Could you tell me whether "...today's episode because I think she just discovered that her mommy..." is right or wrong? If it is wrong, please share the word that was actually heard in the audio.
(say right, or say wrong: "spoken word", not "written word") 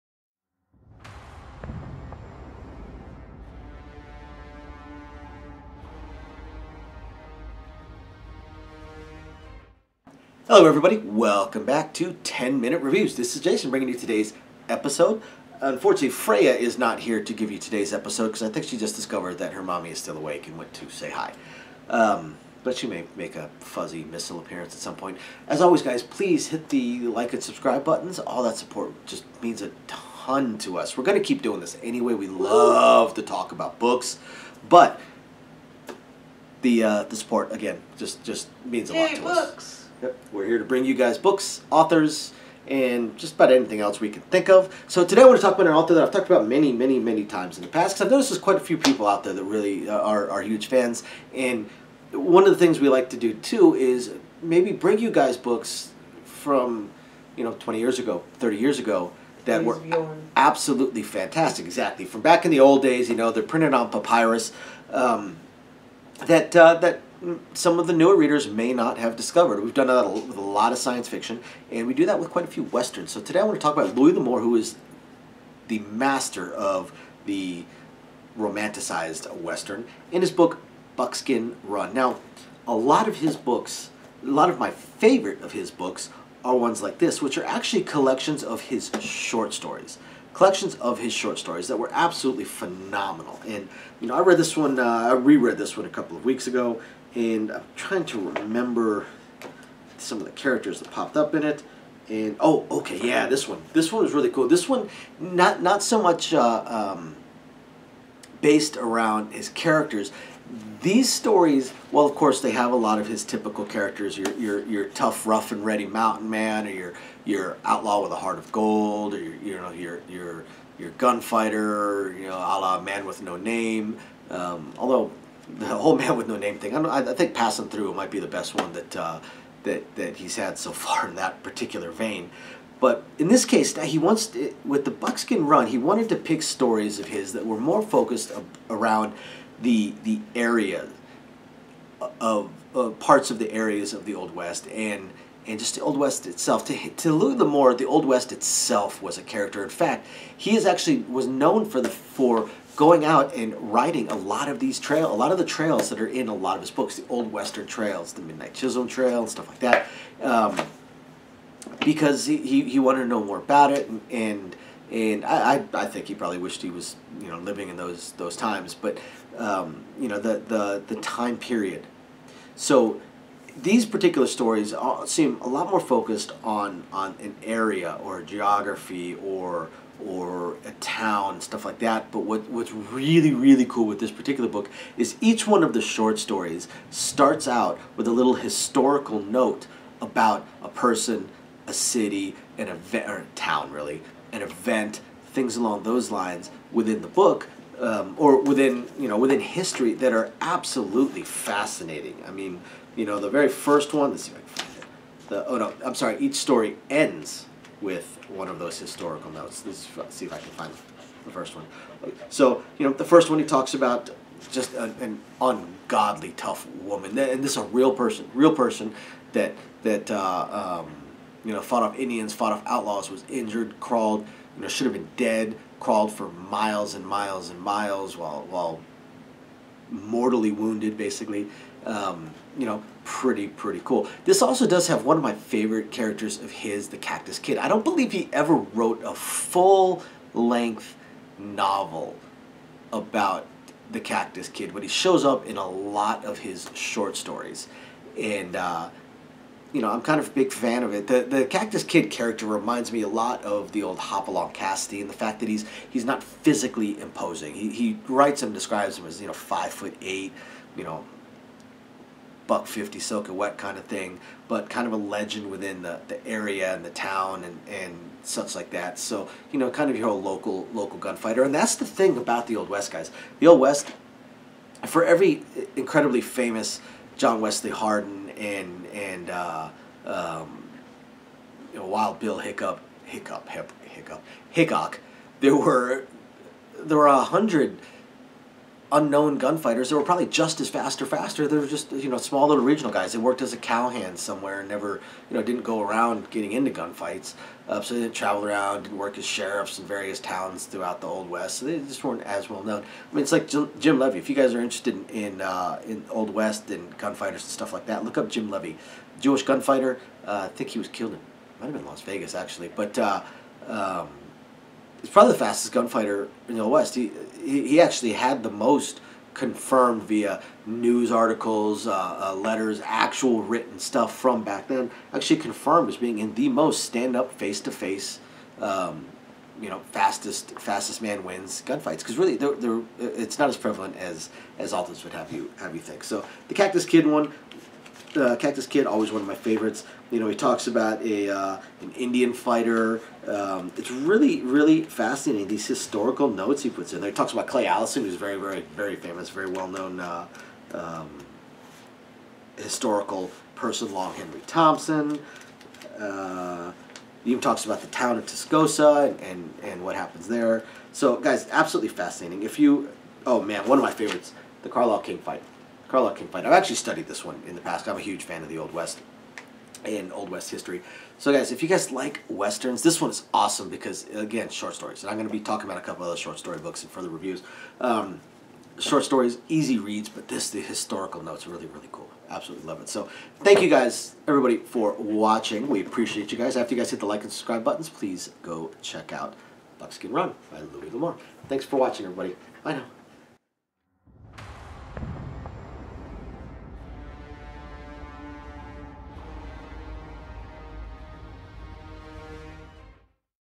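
right.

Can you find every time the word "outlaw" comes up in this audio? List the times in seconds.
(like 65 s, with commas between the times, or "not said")
117 s, 222 s.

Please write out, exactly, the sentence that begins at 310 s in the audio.
Uh, I think he was killed in might have been Las Vegas actually, but.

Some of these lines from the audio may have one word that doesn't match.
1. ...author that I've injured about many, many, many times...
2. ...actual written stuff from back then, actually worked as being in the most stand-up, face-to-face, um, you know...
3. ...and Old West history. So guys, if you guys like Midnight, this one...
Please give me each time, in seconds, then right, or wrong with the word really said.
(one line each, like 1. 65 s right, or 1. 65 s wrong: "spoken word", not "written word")
1. 45 s wrong: "talked", not "injured"
2. 322 s wrong: "confirmed", not "worked"
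3. 369 s wrong: "Westerns", not "Midnight".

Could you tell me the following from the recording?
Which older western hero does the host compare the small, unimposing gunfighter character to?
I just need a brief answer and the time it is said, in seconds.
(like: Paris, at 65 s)
Hopalong Cassidy, at 253 s.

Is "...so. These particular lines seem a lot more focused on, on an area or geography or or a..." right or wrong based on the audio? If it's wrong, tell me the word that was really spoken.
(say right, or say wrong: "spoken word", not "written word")
wrong: "stories", not "lines".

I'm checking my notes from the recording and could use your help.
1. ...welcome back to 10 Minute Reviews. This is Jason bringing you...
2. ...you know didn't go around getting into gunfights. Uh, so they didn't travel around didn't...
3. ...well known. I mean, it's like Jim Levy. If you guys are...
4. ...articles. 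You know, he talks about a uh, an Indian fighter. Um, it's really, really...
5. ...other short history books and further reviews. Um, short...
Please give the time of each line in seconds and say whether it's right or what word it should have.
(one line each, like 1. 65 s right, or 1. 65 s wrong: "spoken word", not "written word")
1. 10 s right
2. 295 s right
3. 302 s right
4. 339 s wrong: "favorites", not "articles"
5. 376 s wrong: "story", not "history".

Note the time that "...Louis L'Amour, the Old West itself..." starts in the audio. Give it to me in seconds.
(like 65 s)
147 s.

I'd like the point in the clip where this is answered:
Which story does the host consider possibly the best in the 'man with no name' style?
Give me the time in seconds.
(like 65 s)
127 s.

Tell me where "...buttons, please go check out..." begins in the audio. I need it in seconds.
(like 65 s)
387 s.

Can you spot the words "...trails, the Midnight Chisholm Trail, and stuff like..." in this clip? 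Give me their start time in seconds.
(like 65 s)
157 s.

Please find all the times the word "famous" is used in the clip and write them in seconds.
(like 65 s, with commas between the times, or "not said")
276 s, 348 s.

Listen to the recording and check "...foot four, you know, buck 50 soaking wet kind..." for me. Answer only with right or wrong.
wrong.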